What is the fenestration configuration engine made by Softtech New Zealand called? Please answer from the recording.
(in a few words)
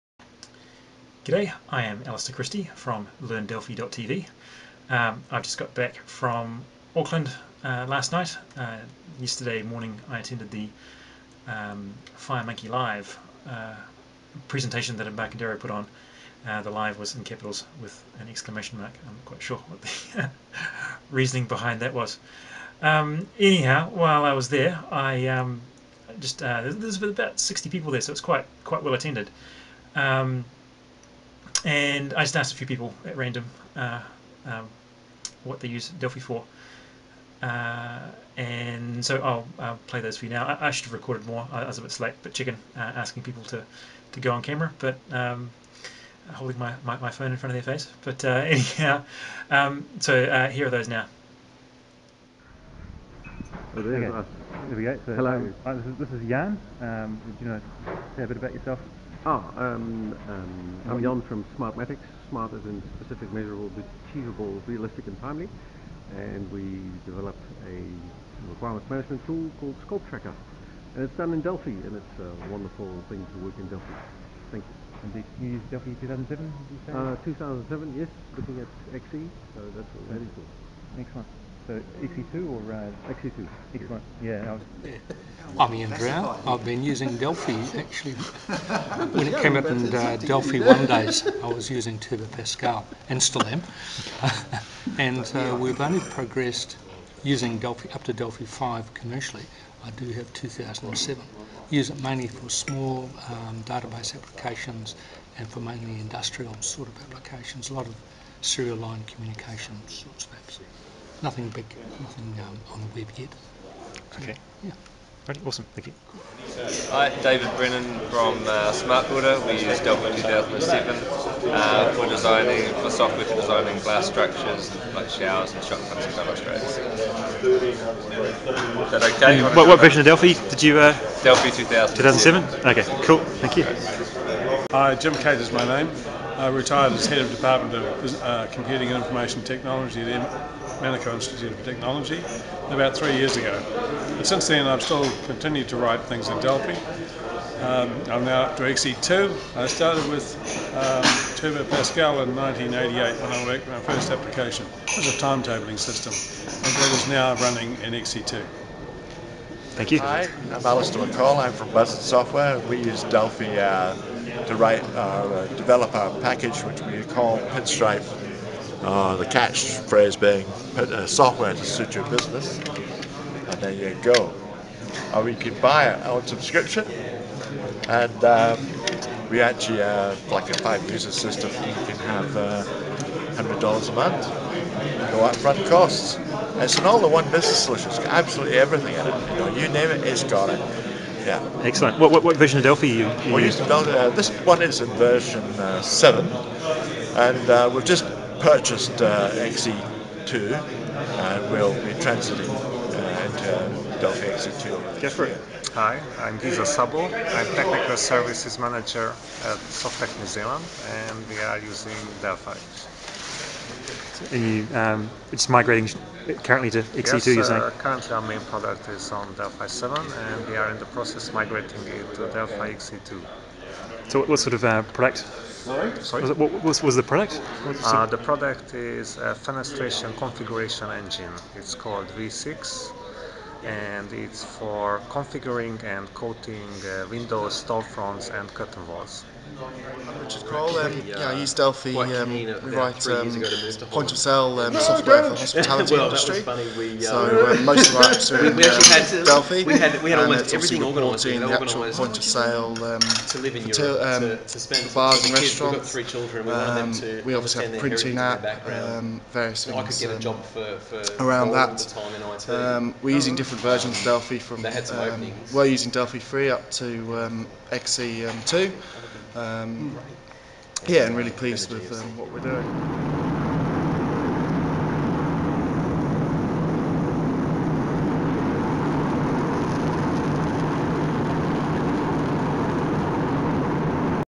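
V6.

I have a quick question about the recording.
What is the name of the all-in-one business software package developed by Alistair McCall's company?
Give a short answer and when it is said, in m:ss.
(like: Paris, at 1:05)
Pinstripe, at 2:47.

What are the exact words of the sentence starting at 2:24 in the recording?
But since then, I've still continued to write things in Delphi.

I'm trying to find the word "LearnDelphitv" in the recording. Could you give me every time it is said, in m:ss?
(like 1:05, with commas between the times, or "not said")
0:03.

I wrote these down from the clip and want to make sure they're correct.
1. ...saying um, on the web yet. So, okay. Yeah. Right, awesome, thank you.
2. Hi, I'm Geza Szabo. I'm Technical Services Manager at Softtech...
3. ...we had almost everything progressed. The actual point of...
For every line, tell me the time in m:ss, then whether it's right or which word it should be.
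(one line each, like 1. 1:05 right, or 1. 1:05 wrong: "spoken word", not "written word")
1. 1:52 wrong: "nothing", not "saying"
2. 3:25 right
3. 4:10 wrong: "organised", not "progressed".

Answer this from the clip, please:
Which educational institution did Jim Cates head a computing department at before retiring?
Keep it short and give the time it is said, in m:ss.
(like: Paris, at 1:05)
Manukau Institute of Technology, at 2:20.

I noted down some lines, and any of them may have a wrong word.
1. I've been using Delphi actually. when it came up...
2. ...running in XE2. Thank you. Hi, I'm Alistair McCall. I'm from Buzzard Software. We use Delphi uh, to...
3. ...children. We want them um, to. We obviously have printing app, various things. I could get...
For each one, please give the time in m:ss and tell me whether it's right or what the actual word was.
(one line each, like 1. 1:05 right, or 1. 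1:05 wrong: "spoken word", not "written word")
1. 1:26 right
2. 2:37 right
3. 4:16 right.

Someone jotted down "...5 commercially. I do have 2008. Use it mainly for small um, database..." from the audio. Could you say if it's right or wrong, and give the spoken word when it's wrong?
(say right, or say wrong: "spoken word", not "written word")
wrong: "2007", not "2008".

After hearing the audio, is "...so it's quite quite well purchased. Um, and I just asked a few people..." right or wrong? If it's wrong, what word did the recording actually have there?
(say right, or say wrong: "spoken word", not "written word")
wrong: "attended", not "purchased".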